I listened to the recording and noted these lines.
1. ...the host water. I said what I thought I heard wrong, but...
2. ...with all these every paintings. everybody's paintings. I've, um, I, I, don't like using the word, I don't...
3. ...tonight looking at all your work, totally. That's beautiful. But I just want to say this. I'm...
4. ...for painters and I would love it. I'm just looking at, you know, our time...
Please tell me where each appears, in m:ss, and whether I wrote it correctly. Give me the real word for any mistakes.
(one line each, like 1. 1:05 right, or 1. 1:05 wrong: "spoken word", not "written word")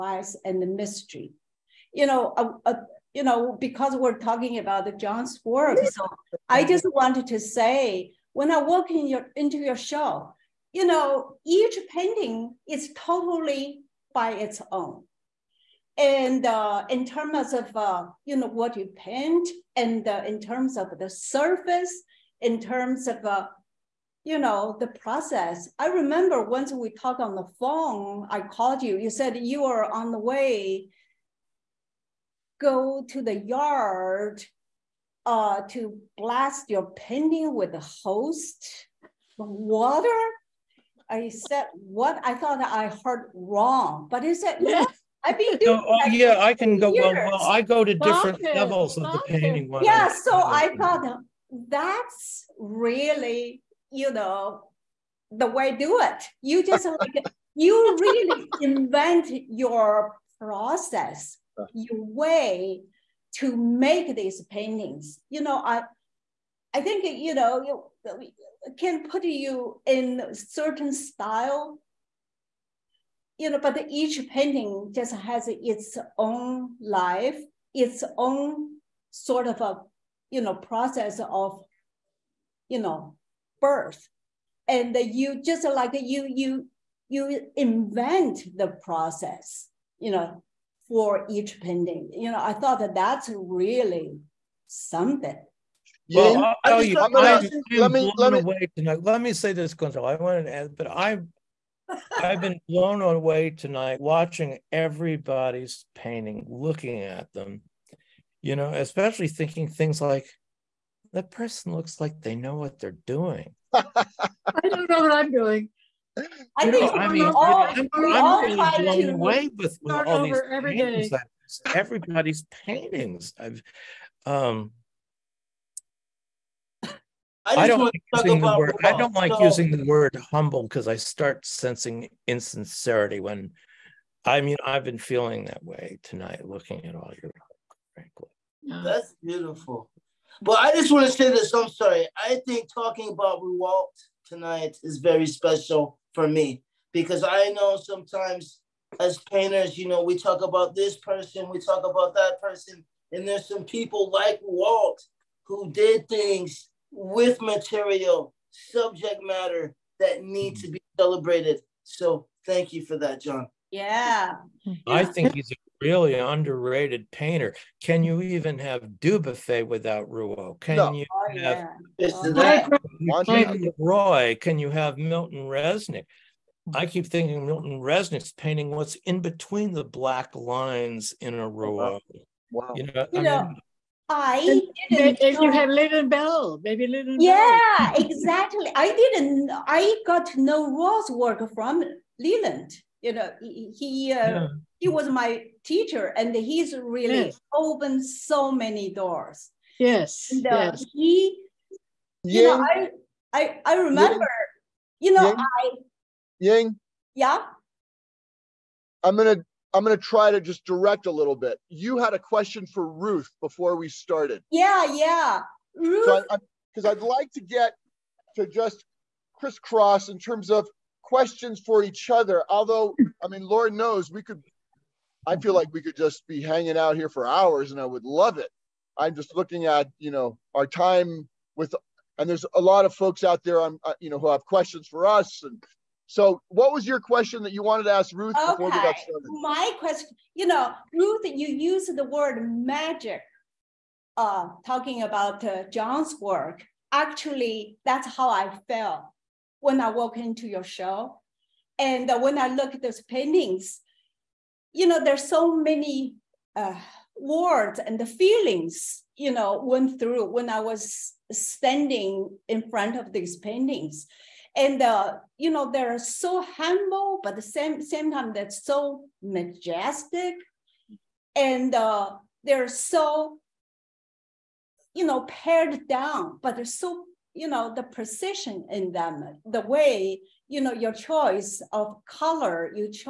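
1. 0:37 right
2. 1:59 right
3. 2:16 wrong: "frankly", not "totally"
4. 3:47 wrong: "hours", not "painters".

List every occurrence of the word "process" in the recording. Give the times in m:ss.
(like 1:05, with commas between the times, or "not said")
0:24, 1:00, 1:20, 1:28.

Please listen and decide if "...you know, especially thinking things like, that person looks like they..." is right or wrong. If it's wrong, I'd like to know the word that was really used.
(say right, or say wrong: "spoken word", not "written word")
right.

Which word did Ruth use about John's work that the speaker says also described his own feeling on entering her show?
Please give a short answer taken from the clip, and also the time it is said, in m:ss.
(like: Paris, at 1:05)
magic, at 4:02.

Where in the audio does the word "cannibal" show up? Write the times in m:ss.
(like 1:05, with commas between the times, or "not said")
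not said.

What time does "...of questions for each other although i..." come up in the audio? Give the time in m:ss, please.
3:40.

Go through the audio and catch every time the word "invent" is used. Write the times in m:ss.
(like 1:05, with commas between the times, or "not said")
0:58, 1:27.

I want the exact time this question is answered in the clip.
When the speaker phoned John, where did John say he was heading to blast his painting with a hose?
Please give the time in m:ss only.
0:33.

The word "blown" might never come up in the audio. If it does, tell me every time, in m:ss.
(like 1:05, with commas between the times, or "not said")
1:38, 1:42, 1:58.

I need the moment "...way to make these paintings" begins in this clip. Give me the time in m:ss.
1:02.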